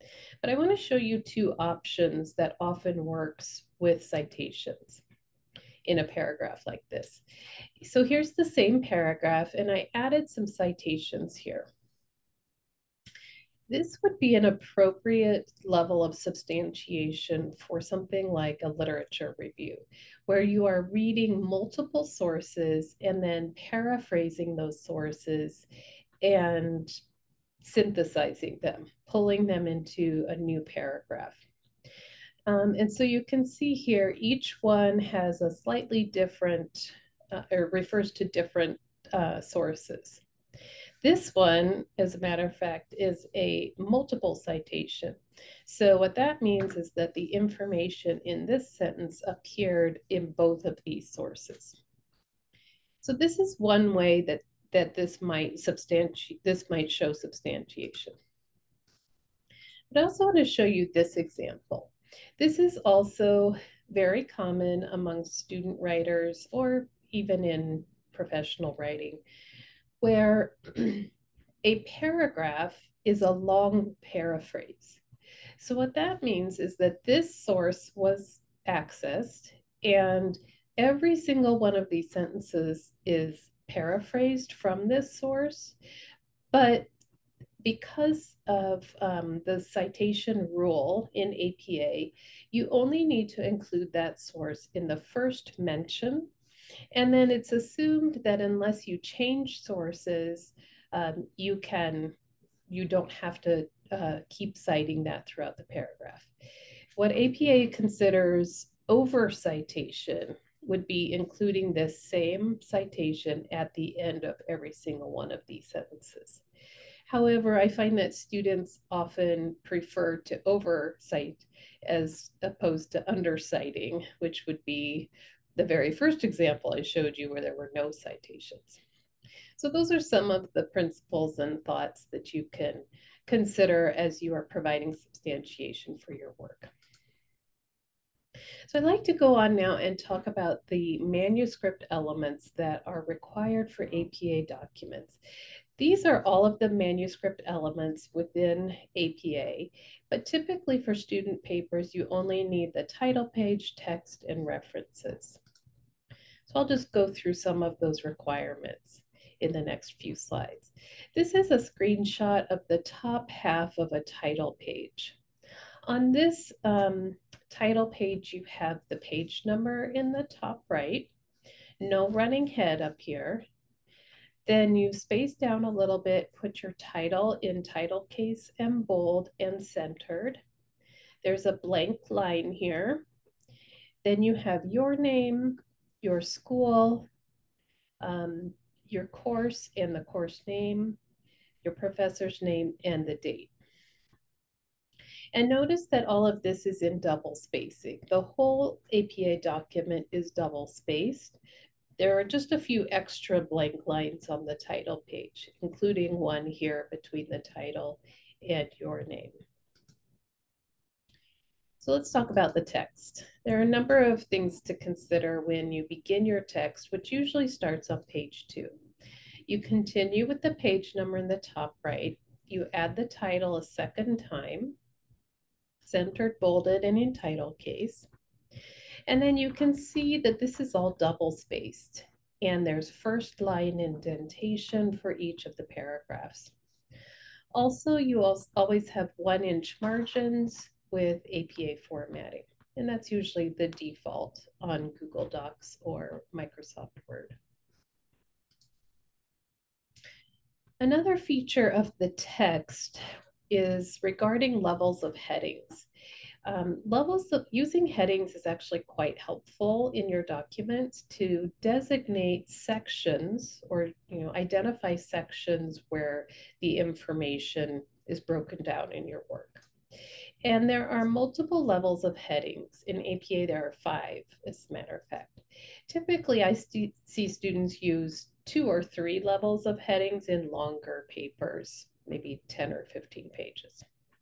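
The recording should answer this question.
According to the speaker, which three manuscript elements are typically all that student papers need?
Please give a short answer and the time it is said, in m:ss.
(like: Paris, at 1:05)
title page, text, and references, at 2:32.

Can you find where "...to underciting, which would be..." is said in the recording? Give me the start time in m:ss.
2:02.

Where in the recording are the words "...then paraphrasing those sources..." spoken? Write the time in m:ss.
0:23.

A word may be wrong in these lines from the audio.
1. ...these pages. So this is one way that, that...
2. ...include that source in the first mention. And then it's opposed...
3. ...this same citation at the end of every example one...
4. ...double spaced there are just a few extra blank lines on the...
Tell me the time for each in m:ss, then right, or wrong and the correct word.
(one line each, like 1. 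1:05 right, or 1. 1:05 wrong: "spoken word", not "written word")
1. 0:50 wrong: "sources", not "pages"
2. 1:33 wrong: "assumed", not "opposed"
3. 1:51 wrong: "single", not "example"
4. 3:20 right.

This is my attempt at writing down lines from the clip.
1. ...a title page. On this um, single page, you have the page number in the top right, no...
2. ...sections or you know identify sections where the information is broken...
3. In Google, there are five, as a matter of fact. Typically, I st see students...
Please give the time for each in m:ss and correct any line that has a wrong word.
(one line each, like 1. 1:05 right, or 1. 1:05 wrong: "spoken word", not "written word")
1. 2:43 wrong: "title", not "single"
2. 4:22 right
3. 4:32 wrong: "APA", not "Google".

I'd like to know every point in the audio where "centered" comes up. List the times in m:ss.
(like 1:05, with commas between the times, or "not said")
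2:59, 3:45.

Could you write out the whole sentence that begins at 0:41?
This one, as a matter of fact, is a multiple citation.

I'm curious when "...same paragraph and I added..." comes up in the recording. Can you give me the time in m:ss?
0:08.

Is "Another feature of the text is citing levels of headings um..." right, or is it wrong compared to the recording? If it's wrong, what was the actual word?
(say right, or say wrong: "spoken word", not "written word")
wrong: "regarding", not "citing".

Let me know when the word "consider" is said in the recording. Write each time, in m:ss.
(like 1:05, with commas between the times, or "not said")
1:47, 2:13, 3:34.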